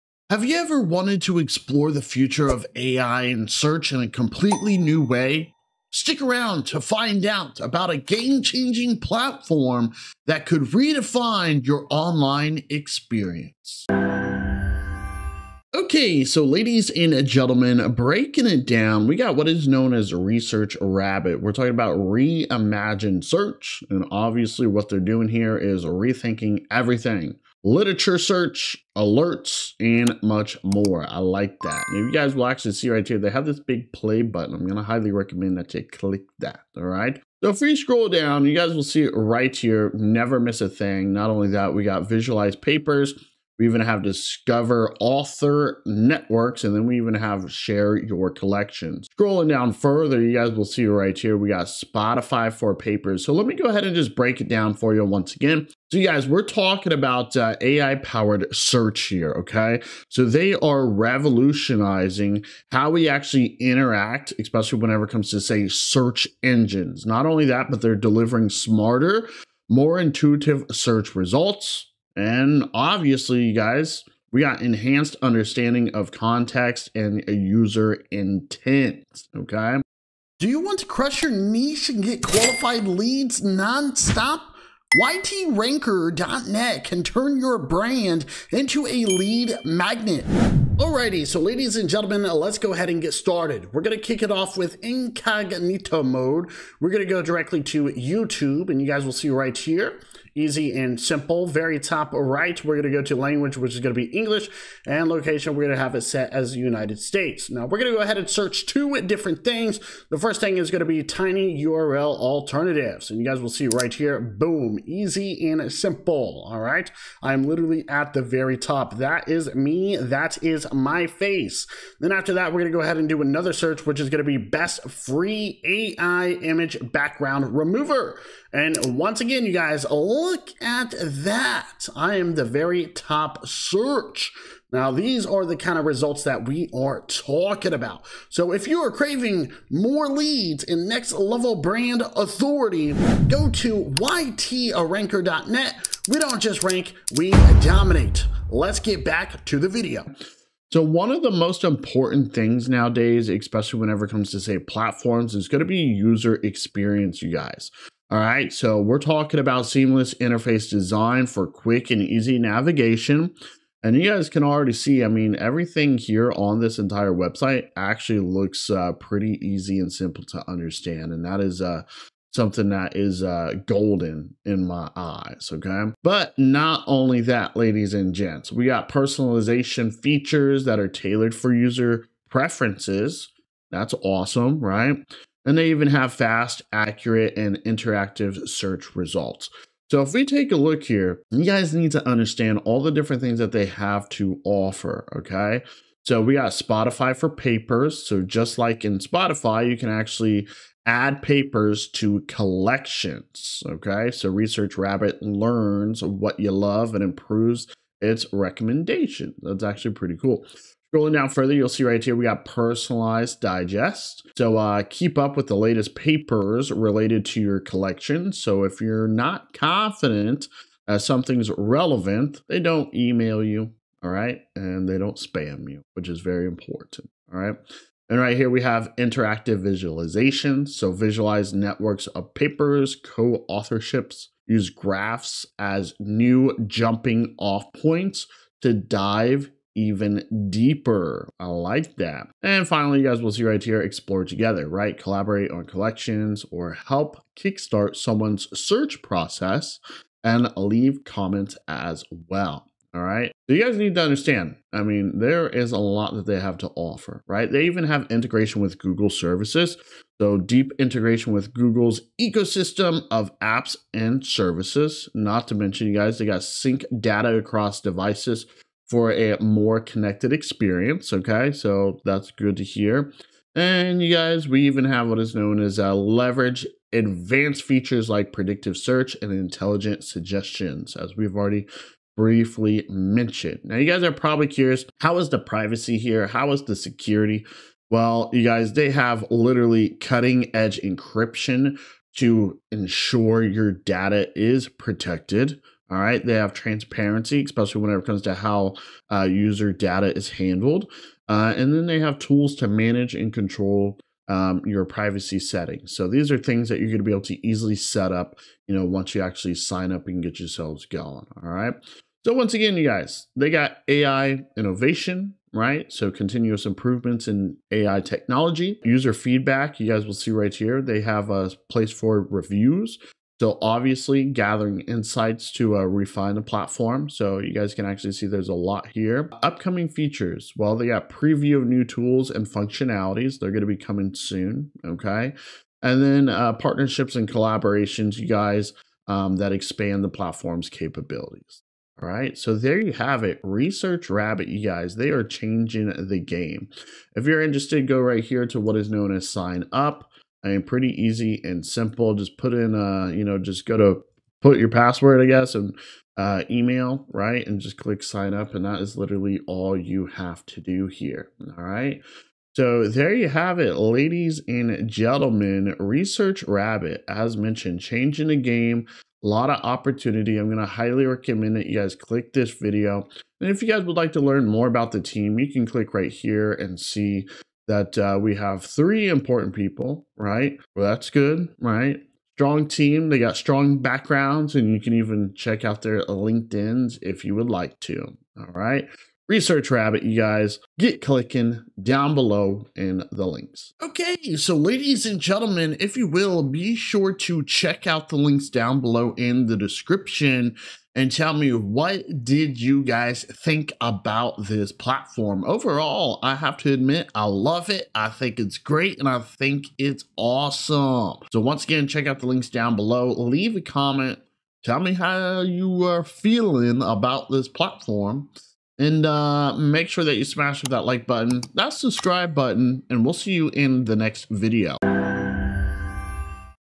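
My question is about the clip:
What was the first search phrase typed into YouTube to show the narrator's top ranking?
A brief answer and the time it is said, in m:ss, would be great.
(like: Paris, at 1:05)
tiny URL alternatives, at 1:51.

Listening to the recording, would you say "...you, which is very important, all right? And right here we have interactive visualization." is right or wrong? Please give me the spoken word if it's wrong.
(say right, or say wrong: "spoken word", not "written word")
right.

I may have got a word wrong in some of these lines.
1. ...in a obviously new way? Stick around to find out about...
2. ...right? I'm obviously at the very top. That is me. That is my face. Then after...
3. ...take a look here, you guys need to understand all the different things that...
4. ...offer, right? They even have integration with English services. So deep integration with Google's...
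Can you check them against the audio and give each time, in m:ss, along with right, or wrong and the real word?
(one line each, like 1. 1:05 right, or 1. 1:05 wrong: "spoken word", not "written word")
1. 0:03 wrong: "completely", not "obviously"
2. 1:56 wrong: "literally", not "obviously"
3. 3:10 right
4. 4:16 wrong: "Google", not "English".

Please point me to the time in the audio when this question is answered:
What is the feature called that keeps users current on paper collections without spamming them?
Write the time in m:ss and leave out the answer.
3:32.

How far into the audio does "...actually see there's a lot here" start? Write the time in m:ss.
5:27.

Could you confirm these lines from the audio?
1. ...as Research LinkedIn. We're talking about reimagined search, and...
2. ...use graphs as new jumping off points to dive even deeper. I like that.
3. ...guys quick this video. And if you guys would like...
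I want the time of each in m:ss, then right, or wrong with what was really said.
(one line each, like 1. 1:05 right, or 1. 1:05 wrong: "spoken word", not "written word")
1. 0:19 wrong: "Rabbit", not "LinkedIn"
2. 3:54 right
3. 6:11 wrong: "click", not "quick".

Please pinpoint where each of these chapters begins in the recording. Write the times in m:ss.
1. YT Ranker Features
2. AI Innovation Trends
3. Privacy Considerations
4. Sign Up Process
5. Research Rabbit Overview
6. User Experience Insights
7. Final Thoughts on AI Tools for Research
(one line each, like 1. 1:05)
1. 1:20
2. 5:12
3. 4:43
4. 5:42
5. 0:18
6. 2:30
7. 6:34.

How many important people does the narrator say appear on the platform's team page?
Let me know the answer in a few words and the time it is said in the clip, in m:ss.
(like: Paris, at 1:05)
3, at 6:18.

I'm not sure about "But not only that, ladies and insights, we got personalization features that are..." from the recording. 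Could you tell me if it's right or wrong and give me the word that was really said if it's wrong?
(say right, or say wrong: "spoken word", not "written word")
wrong: "gents", not "insights".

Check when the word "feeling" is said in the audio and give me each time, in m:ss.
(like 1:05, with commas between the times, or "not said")
6:56.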